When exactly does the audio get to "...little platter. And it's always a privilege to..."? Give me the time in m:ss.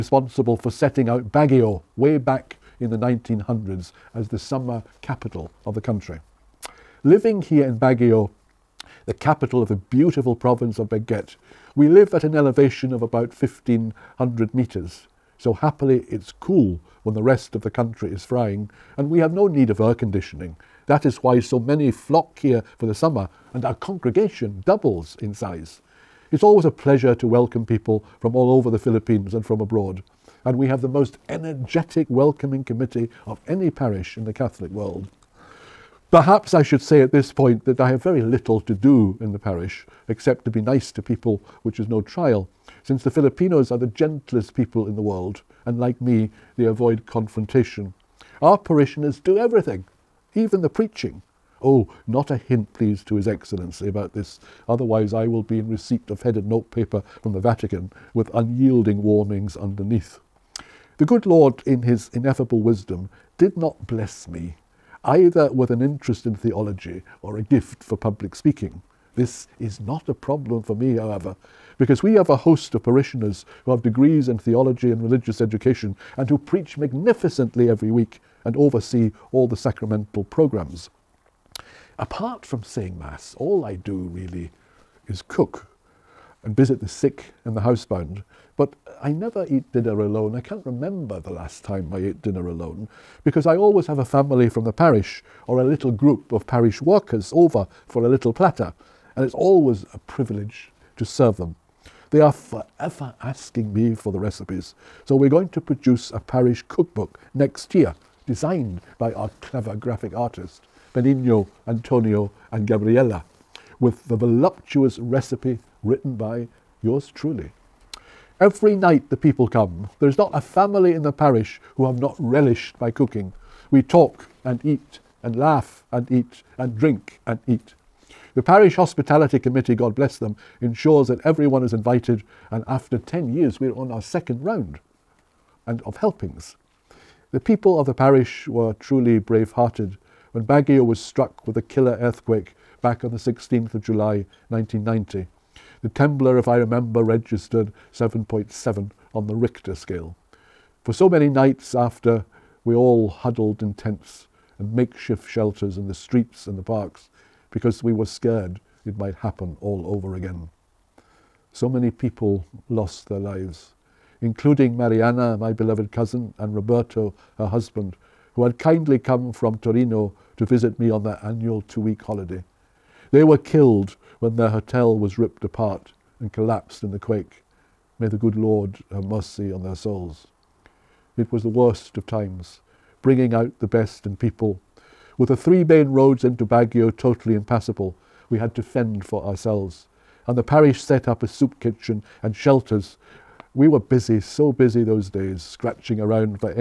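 1:38.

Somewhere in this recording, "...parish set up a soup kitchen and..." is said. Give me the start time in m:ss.
3:10.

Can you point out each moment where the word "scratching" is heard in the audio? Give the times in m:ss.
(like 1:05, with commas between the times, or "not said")
3:15.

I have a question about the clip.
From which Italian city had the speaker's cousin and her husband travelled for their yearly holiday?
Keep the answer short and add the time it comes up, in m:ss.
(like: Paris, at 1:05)
Torino, at 2:49.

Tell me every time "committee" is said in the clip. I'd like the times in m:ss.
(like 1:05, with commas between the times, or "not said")
0:32, 2:09.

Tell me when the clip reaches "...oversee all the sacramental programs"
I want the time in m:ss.
1:18.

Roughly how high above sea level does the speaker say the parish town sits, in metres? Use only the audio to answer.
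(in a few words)
1500 metres.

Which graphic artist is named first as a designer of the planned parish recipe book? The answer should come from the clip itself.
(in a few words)
Benigno.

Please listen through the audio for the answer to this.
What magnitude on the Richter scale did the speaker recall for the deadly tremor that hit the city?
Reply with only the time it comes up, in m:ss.
2:27.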